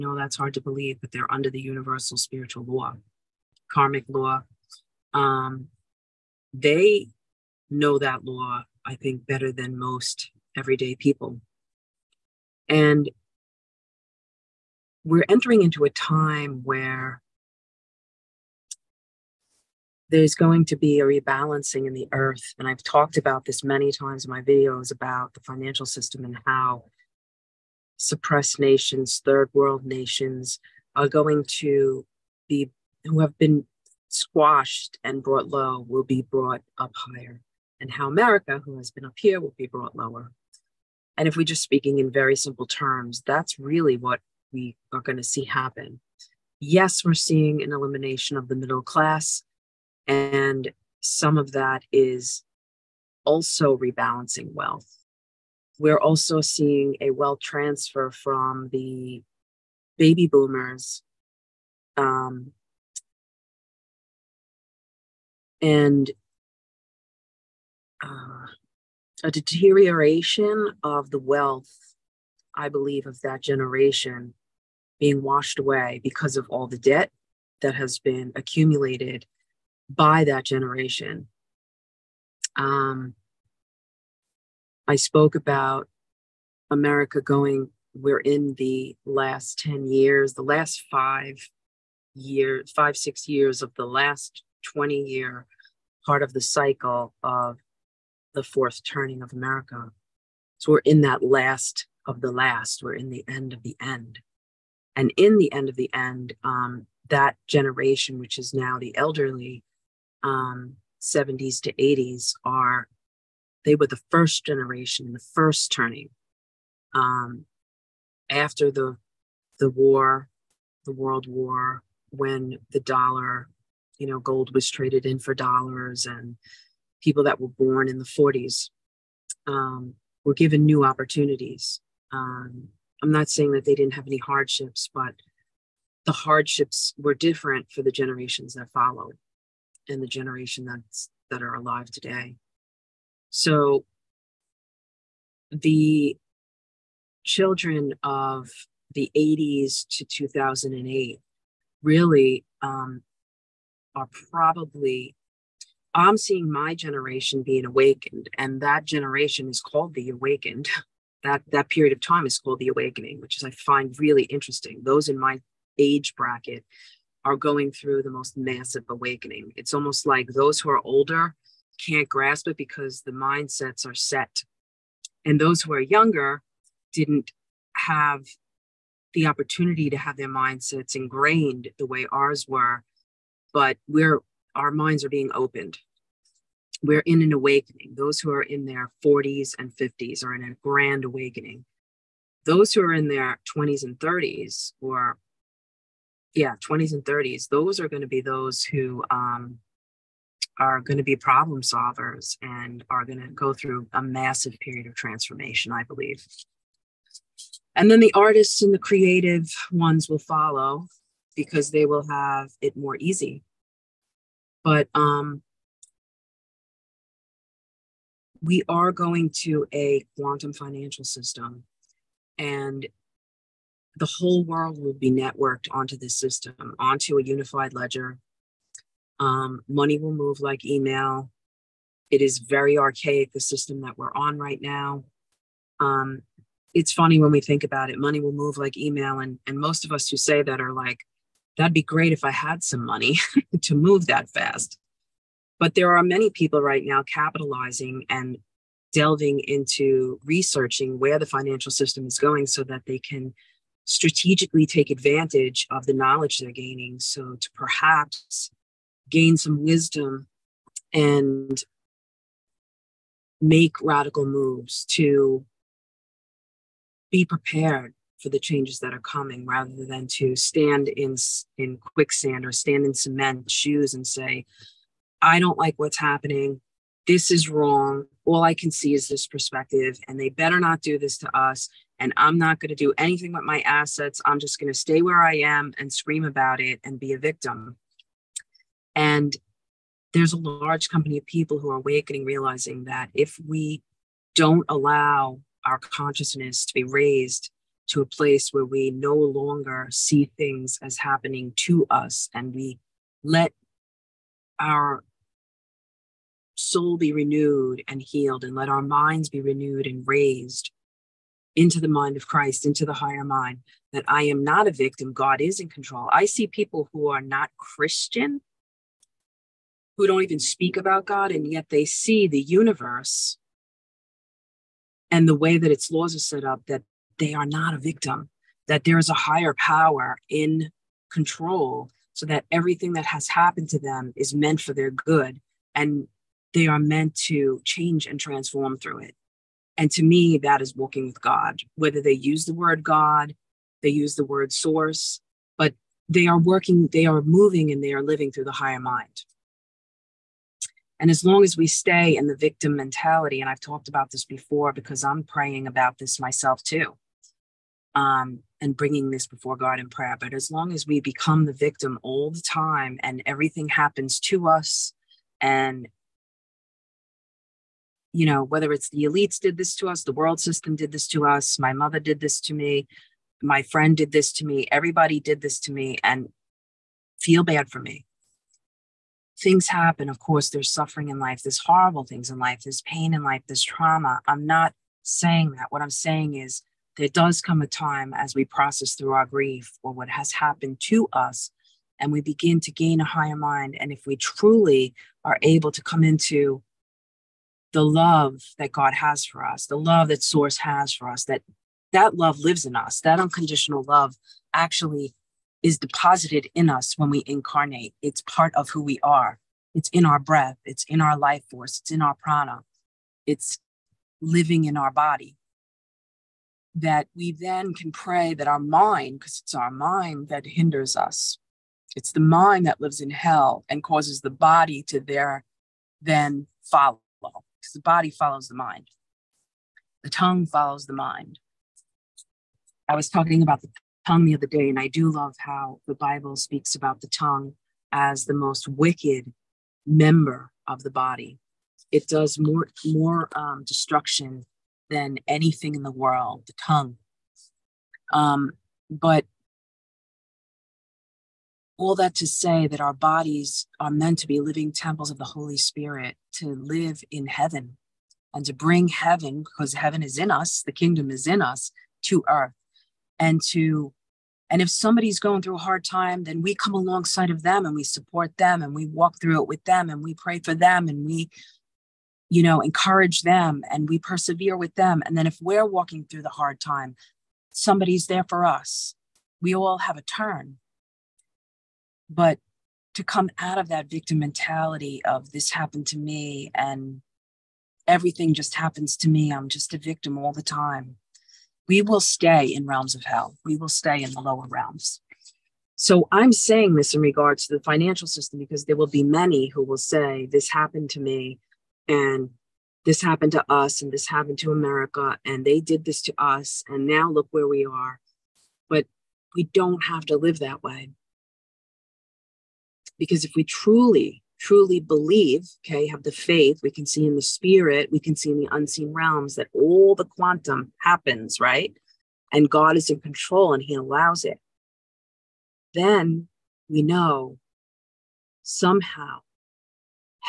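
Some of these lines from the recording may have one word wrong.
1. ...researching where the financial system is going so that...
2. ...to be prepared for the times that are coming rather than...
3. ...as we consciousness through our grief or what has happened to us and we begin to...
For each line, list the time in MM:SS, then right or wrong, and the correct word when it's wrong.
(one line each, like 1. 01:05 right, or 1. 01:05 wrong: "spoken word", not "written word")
1. 04:10 right
2. 04:24 wrong: "changes", not "times"
3. 06:28 wrong: "process", not "consciousness".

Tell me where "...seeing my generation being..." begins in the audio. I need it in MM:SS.
02:36.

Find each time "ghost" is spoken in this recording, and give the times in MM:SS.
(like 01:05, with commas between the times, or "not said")
not said.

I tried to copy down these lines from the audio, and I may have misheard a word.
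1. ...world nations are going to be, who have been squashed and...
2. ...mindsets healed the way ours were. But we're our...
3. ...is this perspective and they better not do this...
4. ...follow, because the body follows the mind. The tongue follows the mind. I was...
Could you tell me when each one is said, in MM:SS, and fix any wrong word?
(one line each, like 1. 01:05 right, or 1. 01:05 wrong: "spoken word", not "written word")
1. 00:29 right
2. 03:00 wrong: "ingrained", not "healed"
3. 04:38 right
4. 07:06 right.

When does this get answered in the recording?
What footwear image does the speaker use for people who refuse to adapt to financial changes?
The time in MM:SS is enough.
04:32.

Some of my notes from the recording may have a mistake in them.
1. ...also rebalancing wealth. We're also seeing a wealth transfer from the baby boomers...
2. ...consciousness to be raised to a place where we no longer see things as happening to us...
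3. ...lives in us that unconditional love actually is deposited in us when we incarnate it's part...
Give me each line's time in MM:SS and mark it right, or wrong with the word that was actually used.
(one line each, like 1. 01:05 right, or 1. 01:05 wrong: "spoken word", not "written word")
1. 00:53 right
2. 04:55 right
3. 06:42 right.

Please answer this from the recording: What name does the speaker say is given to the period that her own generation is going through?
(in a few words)
the awakening.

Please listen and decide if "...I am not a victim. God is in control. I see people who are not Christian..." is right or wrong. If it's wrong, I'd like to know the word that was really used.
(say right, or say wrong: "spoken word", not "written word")
right.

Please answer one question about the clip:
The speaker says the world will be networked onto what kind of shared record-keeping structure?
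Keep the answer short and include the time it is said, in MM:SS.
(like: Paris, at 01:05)
unified ledger, at 03:47.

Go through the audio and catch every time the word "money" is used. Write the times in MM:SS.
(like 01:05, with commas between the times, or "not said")
03:49, 03:57, 04:02.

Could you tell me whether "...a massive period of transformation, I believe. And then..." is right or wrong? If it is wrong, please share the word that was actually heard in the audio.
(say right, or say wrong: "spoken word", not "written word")
right.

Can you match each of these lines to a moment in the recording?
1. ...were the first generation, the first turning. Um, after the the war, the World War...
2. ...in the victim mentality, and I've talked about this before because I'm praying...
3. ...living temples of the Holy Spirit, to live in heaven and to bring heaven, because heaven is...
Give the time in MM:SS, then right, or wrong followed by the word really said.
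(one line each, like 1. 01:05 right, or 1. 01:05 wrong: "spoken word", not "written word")
1. 01:53 right
2. 05:52 right
3. 07:34 right.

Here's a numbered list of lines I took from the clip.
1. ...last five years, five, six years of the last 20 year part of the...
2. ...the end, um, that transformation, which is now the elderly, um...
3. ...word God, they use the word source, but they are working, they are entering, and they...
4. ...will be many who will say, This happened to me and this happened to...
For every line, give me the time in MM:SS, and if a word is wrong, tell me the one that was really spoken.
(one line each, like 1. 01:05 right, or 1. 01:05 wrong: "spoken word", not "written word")
1. 01:30 right
2. 01:45 wrong: "generation", not "transformation"
3. 05:42 wrong: "moving", not "entering"
4. 08:18 right.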